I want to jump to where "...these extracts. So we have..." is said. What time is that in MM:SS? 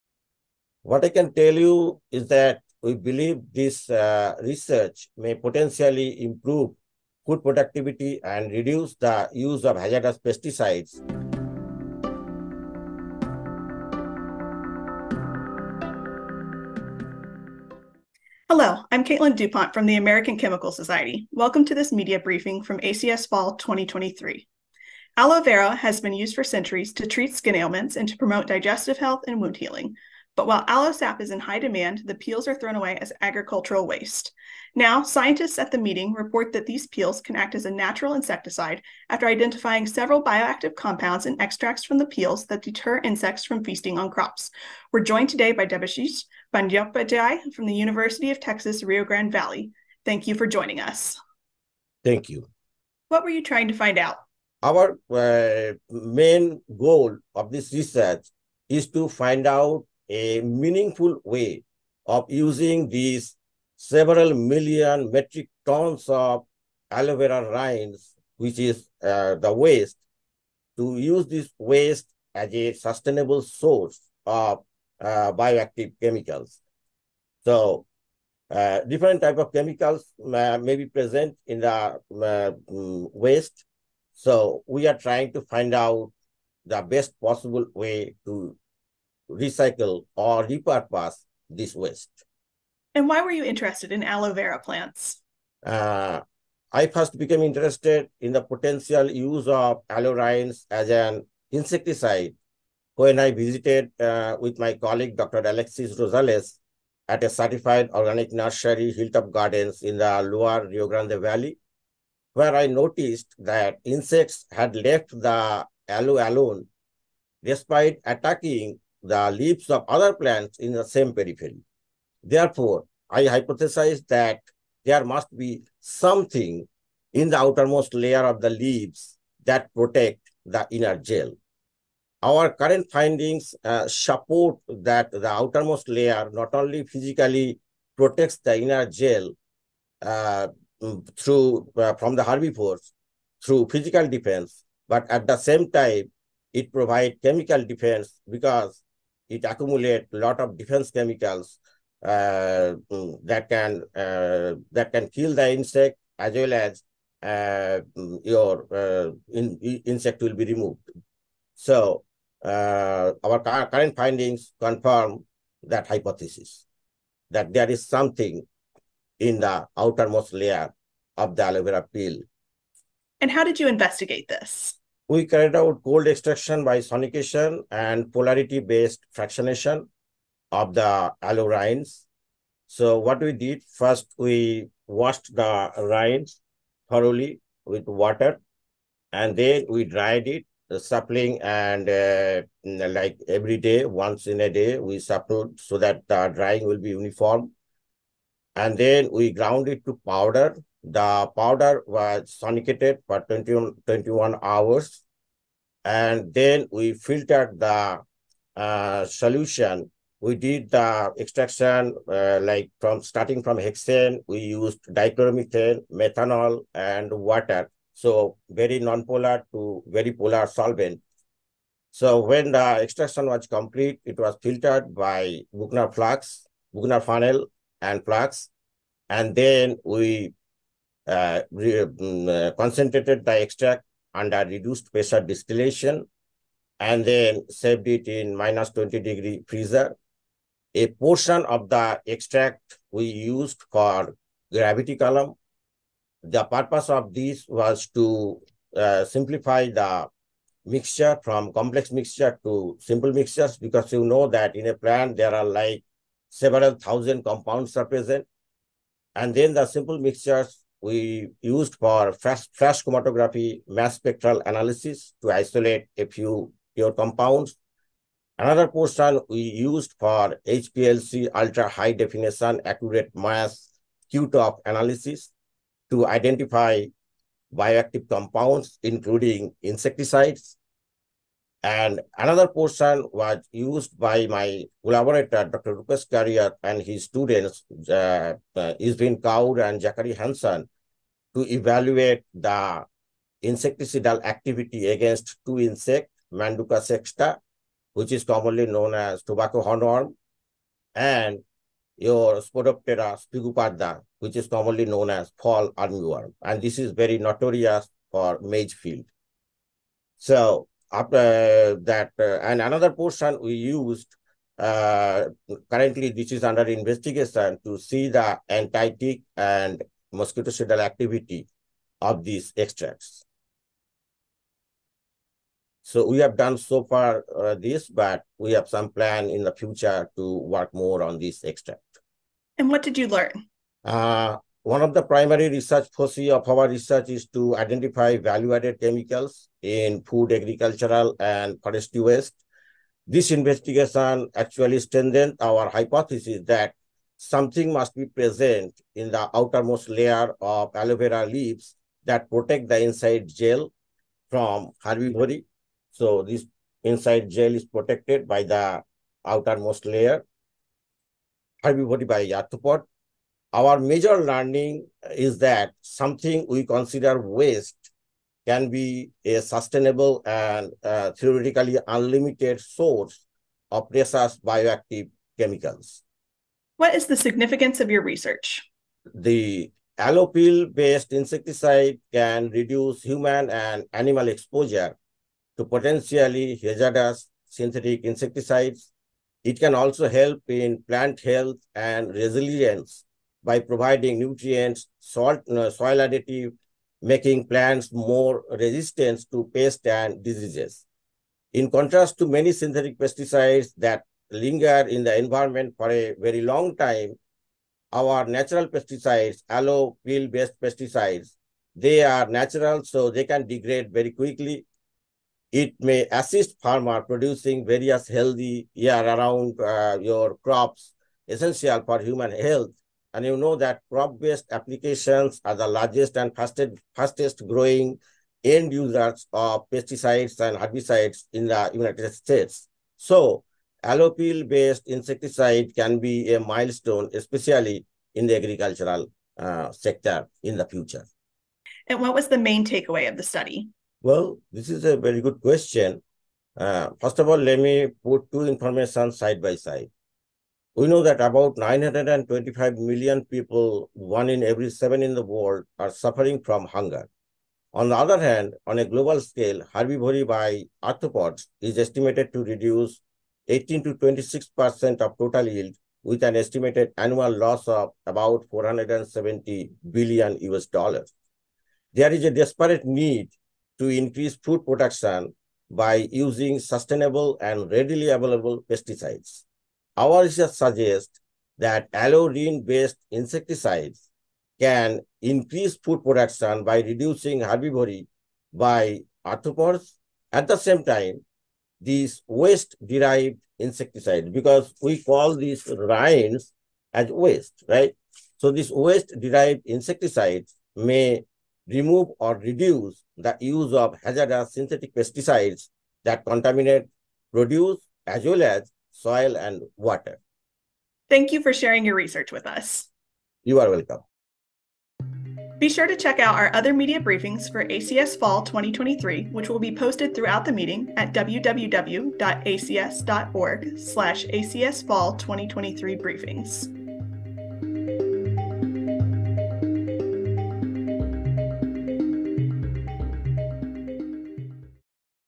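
05:22.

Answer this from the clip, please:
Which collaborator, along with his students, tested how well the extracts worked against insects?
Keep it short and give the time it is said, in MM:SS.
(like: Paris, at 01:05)
Rupesh Kariyat, at 04:45.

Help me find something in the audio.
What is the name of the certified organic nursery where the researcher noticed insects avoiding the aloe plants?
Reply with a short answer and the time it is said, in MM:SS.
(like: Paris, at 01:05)
Hilltop Gardens, at 01:48.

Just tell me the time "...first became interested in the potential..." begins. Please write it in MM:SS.
01:36.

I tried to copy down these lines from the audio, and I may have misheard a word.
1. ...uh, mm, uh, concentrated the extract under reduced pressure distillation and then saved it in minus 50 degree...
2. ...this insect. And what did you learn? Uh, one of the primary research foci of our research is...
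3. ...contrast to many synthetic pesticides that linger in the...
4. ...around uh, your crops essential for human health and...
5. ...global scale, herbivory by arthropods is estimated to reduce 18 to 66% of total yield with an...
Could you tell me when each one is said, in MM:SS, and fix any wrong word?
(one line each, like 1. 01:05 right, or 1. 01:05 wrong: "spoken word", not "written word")
1. 03:51 wrong: "20", not "50"
2. 05:31 wrong: "extract", not "insect"
3. 06:41 right
4. 06:59 right
5. 07:38 wrong: "26", not "66".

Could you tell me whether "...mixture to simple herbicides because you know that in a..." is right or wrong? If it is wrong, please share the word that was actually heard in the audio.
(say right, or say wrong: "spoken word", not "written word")
wrong: "mixtures", not "herbicides".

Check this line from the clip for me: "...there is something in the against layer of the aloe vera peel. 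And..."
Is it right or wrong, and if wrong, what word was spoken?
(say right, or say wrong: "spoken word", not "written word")
wrong: "outermost", not "against".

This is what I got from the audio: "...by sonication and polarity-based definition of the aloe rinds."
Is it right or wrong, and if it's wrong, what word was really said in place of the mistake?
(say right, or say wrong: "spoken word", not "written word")
wrong: "fractionation", not "definition".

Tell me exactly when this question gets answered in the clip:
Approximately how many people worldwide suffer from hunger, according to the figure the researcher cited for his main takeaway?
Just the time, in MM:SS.
07:31.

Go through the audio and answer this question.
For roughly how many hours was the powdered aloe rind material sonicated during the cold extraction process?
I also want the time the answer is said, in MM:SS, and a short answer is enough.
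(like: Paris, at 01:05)
21 hours, at 03:23.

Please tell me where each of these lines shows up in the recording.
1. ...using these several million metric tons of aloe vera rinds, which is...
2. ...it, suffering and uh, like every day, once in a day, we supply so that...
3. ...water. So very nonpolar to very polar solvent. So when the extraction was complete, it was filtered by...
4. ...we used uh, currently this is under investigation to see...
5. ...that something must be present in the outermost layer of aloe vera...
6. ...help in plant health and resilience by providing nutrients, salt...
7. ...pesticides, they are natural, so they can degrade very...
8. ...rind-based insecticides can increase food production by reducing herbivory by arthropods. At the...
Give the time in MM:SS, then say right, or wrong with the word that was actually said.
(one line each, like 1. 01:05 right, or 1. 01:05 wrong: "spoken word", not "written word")
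1. 01:02 right
2. 03:10 wrong: "suppling", not "suffering"
3. 03:37 right
4. 05:13 right
5. 05:46 right
6. 06:30 right
7. 06:50 right
8. 08:02 right.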